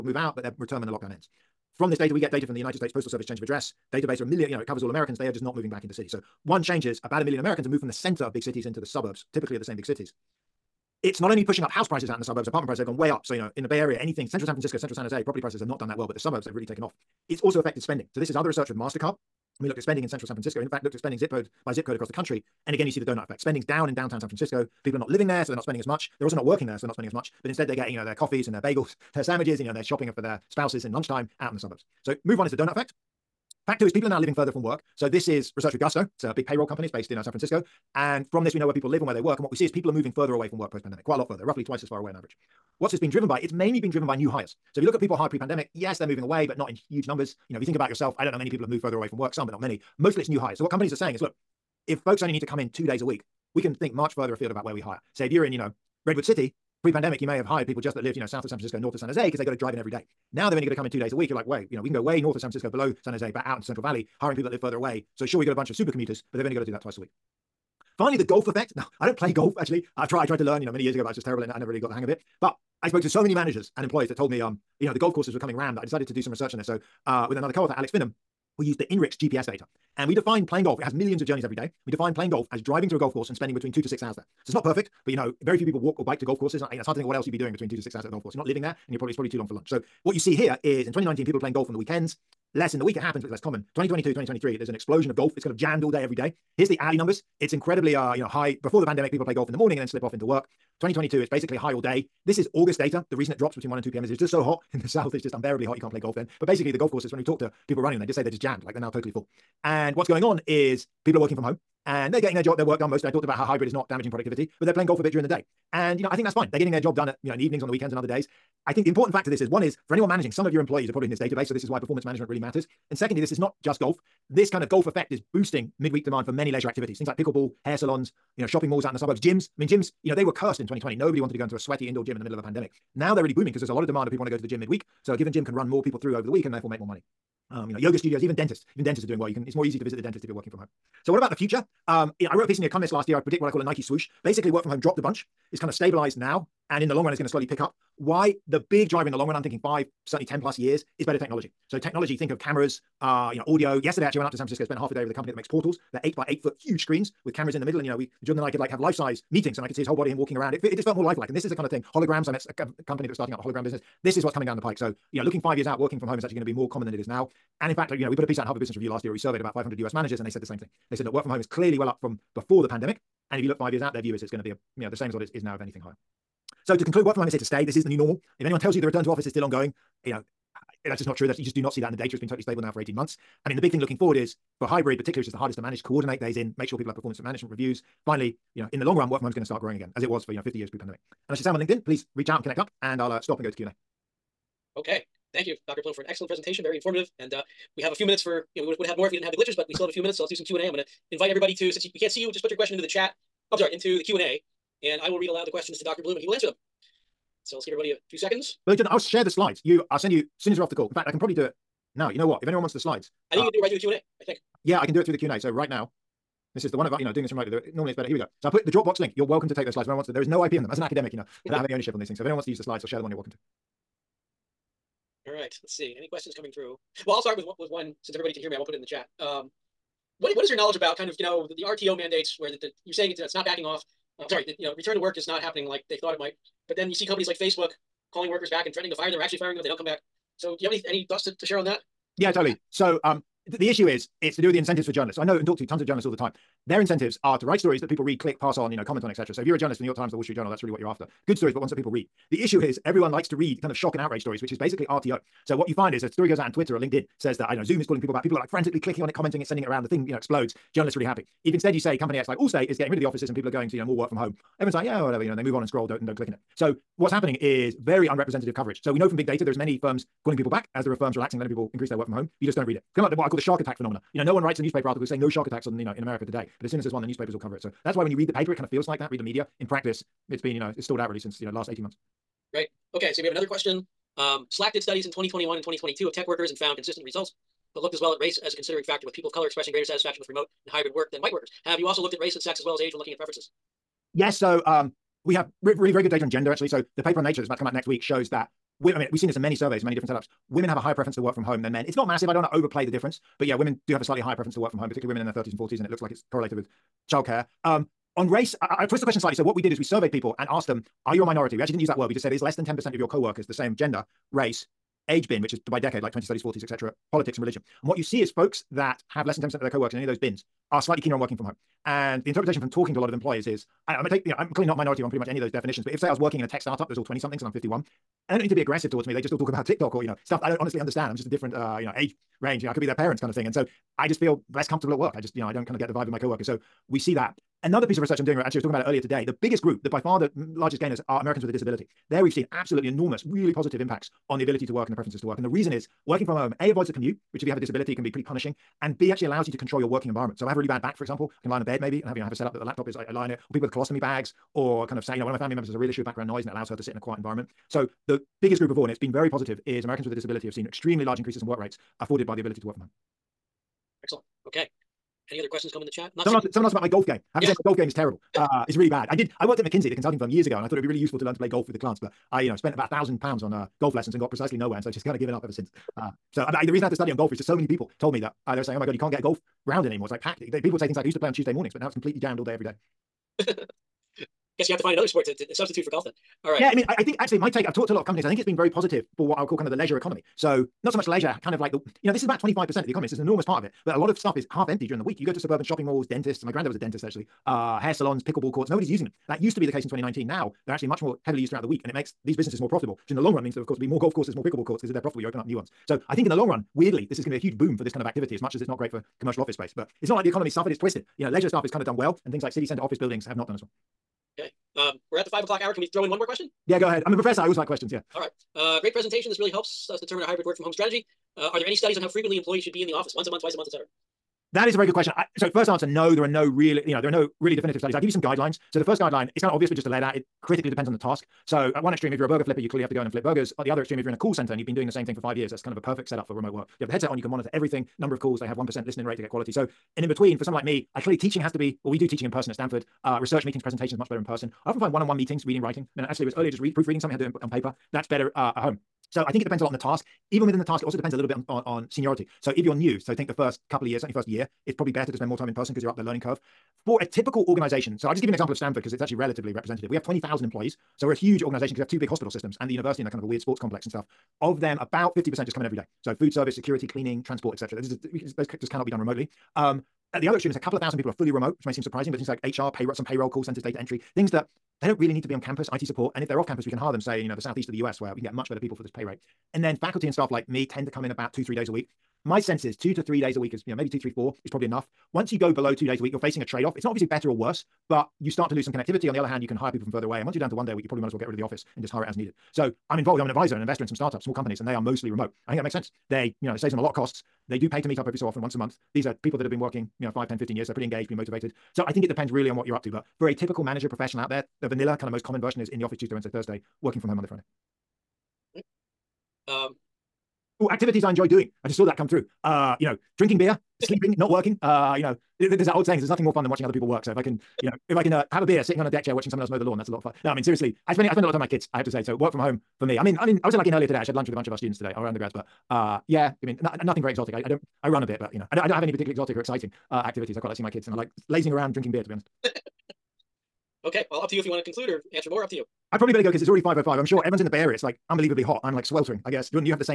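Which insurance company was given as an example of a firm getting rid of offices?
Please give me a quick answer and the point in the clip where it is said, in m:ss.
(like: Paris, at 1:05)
Allstate, at 4:22.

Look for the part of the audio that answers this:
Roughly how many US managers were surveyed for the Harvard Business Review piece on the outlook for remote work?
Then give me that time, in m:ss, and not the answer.
2:49.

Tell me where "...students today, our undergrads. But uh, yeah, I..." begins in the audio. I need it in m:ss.
8:44.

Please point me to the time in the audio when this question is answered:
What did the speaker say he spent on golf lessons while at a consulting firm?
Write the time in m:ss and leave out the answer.
6:12.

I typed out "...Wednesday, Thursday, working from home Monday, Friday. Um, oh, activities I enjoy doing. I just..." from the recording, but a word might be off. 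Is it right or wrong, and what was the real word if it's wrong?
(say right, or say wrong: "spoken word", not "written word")
right.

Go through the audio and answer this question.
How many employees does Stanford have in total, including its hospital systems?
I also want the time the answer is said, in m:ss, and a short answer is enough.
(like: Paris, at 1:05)
20,000, at 7:40.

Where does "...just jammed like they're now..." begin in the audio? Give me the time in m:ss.
1:48.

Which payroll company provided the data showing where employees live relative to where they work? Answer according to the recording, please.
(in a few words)
Gusto.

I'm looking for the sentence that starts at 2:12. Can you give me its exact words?
Now they're really booming because there's a lot of demand of people want to go to the gym midweek.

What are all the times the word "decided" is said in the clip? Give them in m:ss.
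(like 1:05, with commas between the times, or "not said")
1:15.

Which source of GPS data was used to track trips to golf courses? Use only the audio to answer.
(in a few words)
INRIX.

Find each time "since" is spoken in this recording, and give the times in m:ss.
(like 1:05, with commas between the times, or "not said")
3:21, 3:48, 4:41, 6:15.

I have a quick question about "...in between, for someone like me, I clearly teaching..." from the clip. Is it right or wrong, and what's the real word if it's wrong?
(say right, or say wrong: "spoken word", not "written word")
right.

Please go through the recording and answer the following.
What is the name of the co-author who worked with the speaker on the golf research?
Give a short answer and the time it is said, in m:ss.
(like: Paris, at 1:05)
Alex Finham, at 1:17.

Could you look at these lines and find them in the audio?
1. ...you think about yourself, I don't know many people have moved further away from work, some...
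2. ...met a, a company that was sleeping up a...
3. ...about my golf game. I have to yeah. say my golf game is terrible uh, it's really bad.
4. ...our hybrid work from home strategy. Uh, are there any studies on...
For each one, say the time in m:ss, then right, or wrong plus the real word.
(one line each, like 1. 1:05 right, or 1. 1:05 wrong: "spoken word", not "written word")
1. 0:47 right
2. 2:42 wrong: "starting", not "sleeping"
3. 6:06 right
4. 7:00 right.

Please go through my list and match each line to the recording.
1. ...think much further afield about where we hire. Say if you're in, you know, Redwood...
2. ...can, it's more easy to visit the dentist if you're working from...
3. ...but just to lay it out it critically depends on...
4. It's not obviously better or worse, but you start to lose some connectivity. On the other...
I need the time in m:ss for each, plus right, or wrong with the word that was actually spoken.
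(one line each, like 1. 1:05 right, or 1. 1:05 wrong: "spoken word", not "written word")
1. 0:53 right
2. 2:19 right
3. 7:09 right
4. 8:06 right.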